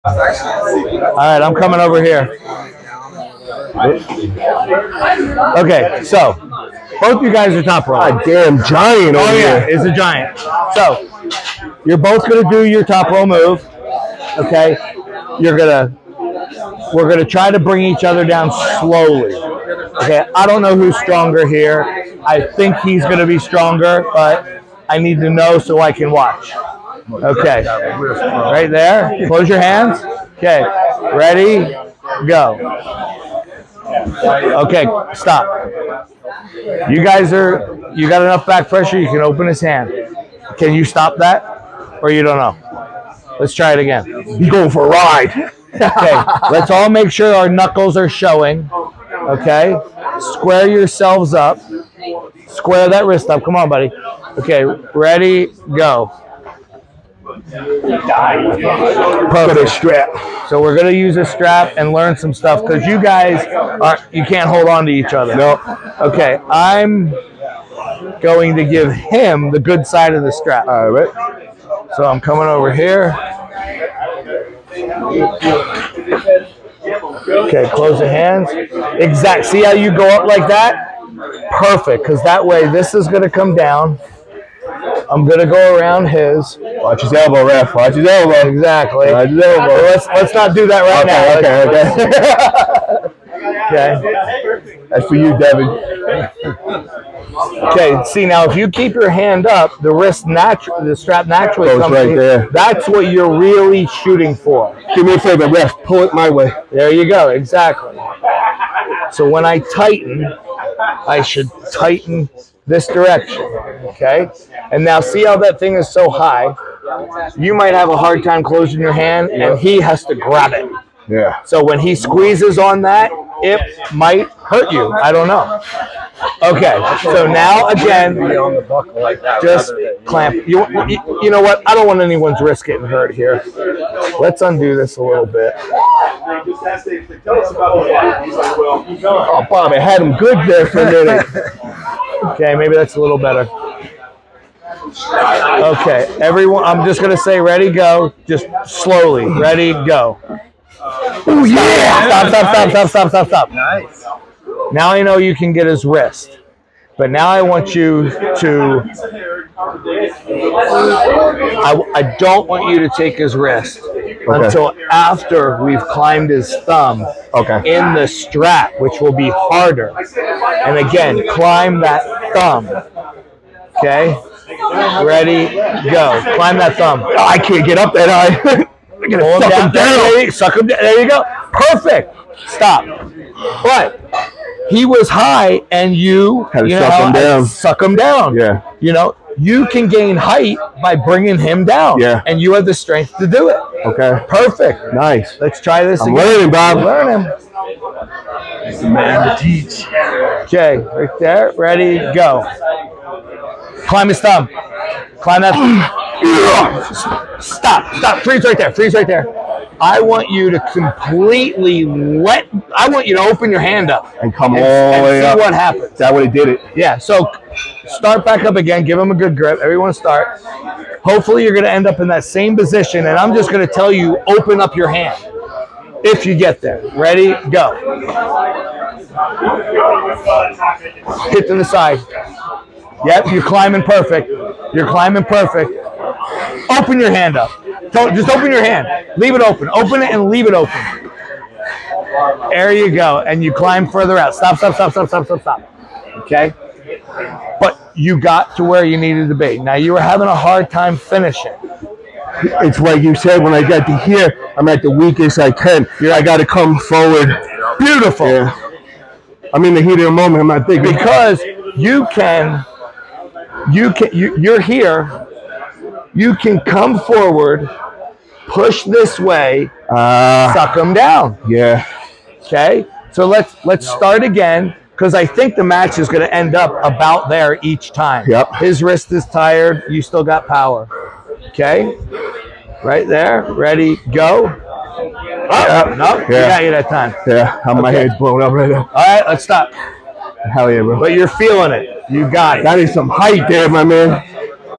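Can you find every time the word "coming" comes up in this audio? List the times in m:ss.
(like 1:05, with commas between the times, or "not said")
0:01, 1:12.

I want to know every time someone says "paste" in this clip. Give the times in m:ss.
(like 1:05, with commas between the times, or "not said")
not said.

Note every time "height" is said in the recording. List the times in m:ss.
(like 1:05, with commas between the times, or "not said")
3:10, 4:53.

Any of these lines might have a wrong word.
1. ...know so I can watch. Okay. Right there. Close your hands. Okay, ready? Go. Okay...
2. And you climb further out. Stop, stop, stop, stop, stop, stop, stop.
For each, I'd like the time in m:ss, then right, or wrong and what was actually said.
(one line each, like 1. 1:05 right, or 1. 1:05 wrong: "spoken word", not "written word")
1. 0:25 right
2. 4:03 right.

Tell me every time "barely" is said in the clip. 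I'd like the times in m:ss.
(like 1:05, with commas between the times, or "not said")
not said.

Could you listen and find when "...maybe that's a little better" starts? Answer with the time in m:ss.
2:22.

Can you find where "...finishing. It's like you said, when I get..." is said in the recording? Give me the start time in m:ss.
4:10.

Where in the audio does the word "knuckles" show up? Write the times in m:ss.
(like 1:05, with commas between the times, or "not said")
0:47.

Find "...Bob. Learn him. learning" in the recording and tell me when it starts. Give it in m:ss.
3:16.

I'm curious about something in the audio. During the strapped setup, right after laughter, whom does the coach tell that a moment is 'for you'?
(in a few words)
Devin.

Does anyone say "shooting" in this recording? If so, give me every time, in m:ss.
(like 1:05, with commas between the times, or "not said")
1:43.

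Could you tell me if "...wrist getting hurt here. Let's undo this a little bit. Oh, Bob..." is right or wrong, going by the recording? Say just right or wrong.
right.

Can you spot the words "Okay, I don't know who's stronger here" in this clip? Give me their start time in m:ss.
0:20.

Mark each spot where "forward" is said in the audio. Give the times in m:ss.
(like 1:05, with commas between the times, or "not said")
4:16, 4:26.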